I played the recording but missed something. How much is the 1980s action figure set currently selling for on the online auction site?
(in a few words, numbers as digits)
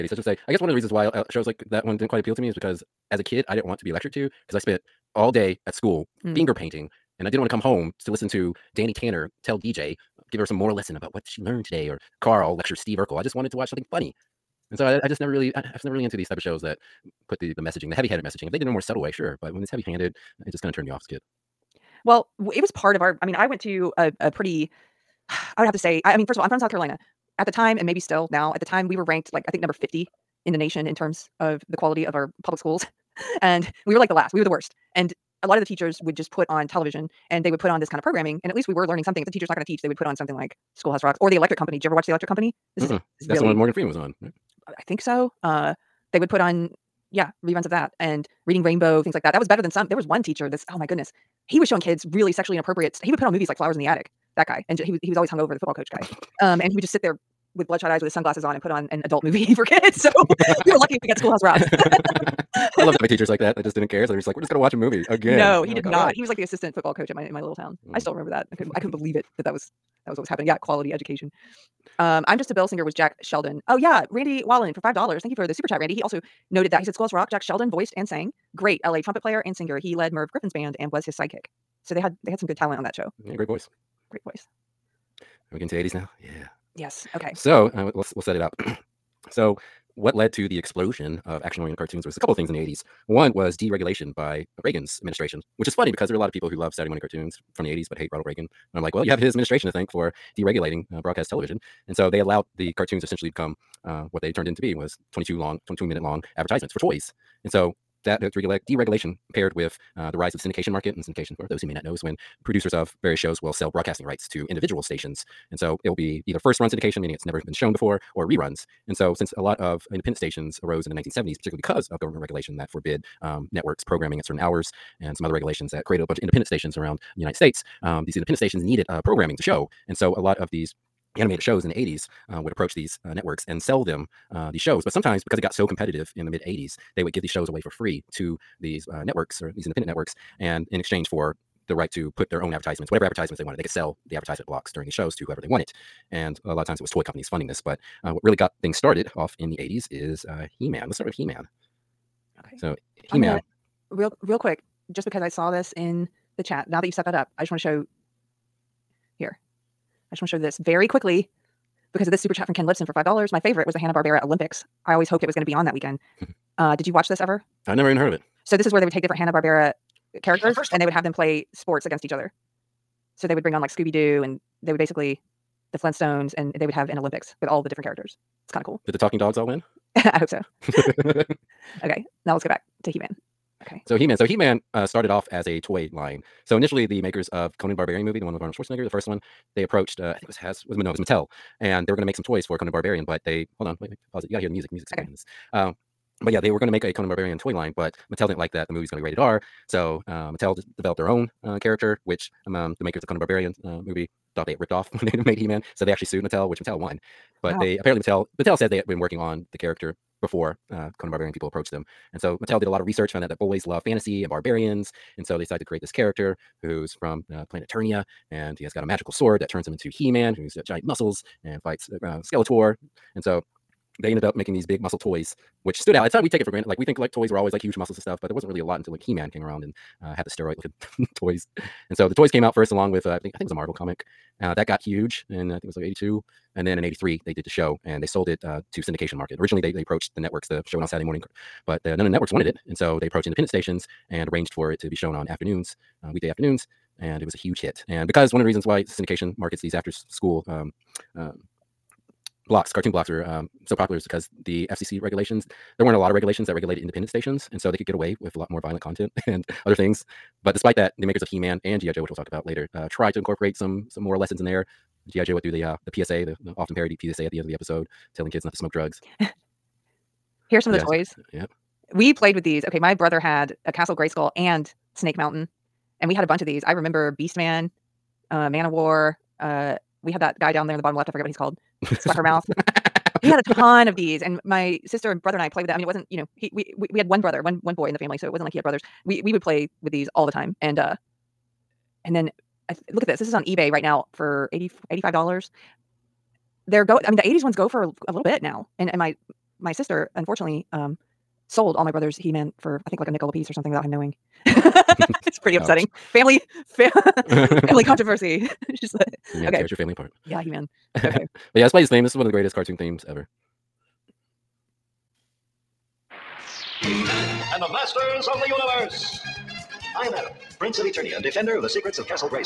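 $85.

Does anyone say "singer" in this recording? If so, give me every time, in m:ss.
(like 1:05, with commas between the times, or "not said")
1:12, 1:19.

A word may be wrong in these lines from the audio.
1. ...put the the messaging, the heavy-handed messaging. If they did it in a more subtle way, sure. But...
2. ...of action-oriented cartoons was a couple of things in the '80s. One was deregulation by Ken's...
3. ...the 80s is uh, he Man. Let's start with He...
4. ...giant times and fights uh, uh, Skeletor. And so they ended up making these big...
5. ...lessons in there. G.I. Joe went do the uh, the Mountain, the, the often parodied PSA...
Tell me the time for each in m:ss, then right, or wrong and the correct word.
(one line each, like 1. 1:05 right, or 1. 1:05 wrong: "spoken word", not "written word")
1. 0:17 right
2. 1:31 wrong: "Reagan", not "Ken"
3. 2:29 right
4. 3:40 wrong: "muscles", not "times"
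5. 4:24 wrong: "PSA", not "Mountain".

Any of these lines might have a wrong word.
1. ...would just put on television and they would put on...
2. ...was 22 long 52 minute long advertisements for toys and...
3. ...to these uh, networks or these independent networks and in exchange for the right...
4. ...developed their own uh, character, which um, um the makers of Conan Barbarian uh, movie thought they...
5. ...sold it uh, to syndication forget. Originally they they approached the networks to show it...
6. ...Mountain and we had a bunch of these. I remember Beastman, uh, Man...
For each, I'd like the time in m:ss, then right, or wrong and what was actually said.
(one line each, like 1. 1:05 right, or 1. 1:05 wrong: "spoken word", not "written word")
1. 0:36 right
2. 1:44 wrong: "22", not "52"
3. 2:18 right
4. 3:20 right
5. 3:58 wrong: "market", not "forget"
6. 4:35 right.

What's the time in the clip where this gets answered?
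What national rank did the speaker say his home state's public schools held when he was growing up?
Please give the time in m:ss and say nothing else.
0:29.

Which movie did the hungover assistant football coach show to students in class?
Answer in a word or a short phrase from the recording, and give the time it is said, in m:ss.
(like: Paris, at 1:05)
Flowers in the Attic, at 0:53.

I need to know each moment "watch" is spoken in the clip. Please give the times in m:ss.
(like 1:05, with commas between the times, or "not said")
0:13, 0:41, 1:04, 2:46.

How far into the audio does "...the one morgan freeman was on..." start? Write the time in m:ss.
0:43.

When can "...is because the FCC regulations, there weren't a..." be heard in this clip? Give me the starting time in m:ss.
4:13.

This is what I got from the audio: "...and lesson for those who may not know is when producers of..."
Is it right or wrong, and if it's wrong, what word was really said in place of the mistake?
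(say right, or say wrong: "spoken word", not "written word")
wrong: "syndication", not "lesson".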